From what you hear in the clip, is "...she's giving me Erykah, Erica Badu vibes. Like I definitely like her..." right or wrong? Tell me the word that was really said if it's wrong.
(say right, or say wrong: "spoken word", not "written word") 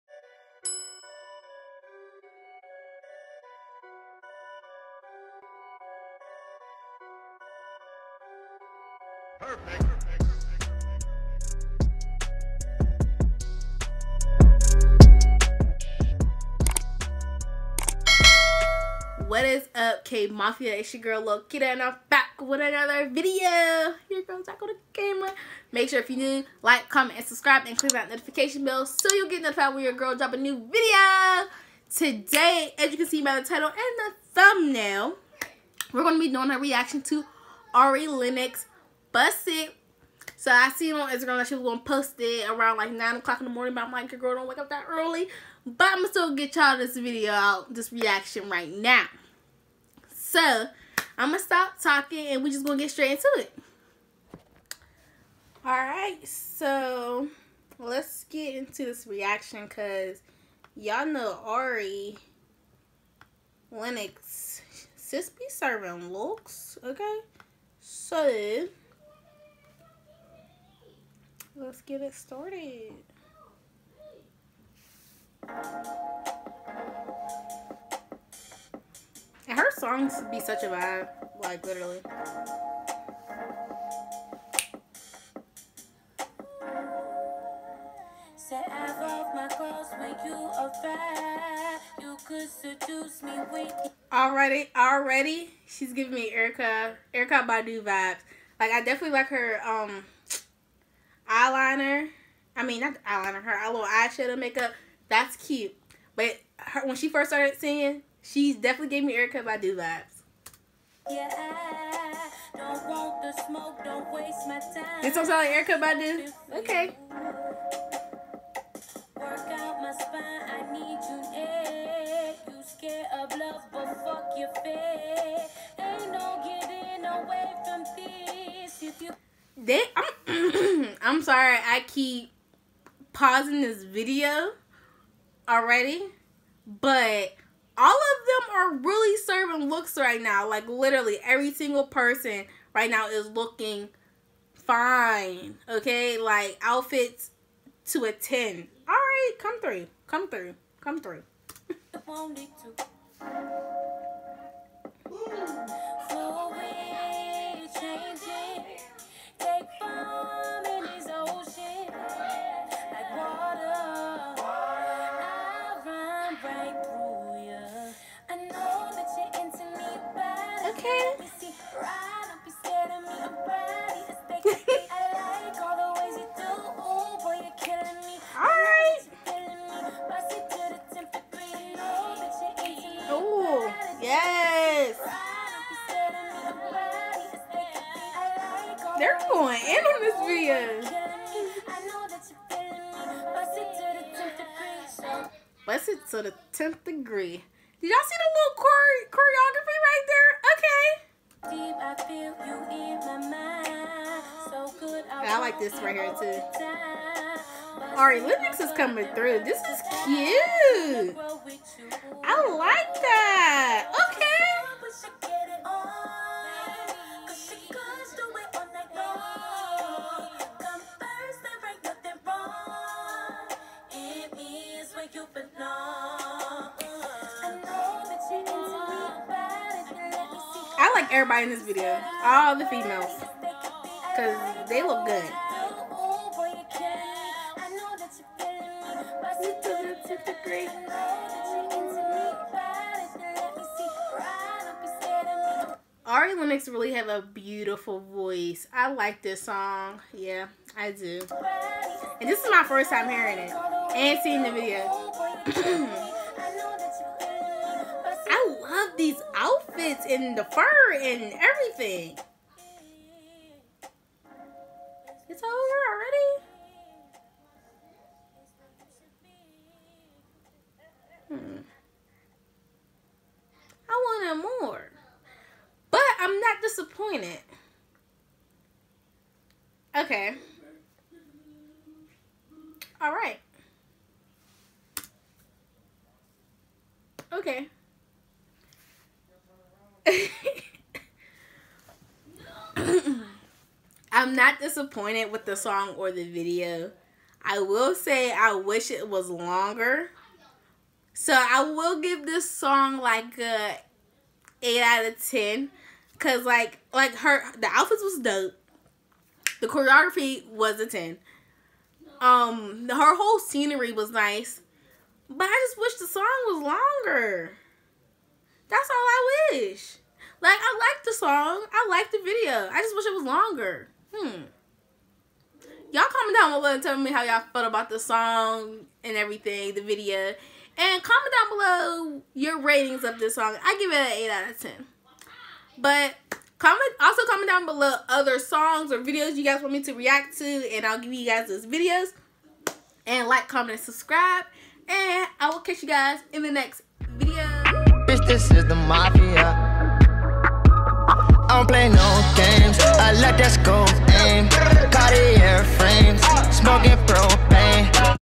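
wrong: "Erykah", not "Erica".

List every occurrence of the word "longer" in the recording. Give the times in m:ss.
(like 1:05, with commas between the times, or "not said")
4:59, 5:16, 5:23.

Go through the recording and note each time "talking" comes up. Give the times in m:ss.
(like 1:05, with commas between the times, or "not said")
0:51.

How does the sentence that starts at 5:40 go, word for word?
And I'll give you guys those videos.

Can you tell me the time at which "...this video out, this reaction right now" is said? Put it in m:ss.
0:46.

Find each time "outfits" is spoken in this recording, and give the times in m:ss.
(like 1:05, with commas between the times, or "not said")
2:26, 4:19, 5:07.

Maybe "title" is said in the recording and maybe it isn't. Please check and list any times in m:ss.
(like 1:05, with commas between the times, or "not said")
0:33.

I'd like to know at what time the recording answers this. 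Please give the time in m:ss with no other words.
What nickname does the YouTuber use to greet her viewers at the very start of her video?
0:20.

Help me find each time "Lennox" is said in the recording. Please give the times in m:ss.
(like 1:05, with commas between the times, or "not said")
0:38, 1:03, 3:28, 4:06.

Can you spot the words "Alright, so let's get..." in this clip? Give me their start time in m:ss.
0:55.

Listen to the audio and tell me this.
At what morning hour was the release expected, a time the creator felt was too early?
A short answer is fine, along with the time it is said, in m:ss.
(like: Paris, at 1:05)
9 o'clock, at 0:42.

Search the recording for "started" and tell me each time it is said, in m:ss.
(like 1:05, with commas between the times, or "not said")
1:12, 1:47.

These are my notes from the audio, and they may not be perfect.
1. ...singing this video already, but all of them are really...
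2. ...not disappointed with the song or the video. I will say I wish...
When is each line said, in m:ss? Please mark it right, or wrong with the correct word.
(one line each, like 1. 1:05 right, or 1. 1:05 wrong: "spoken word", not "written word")
1. 2:13 wrong: "pausing", not "singing"
2. 4:54 right.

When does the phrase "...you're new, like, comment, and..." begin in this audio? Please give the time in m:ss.
0:26.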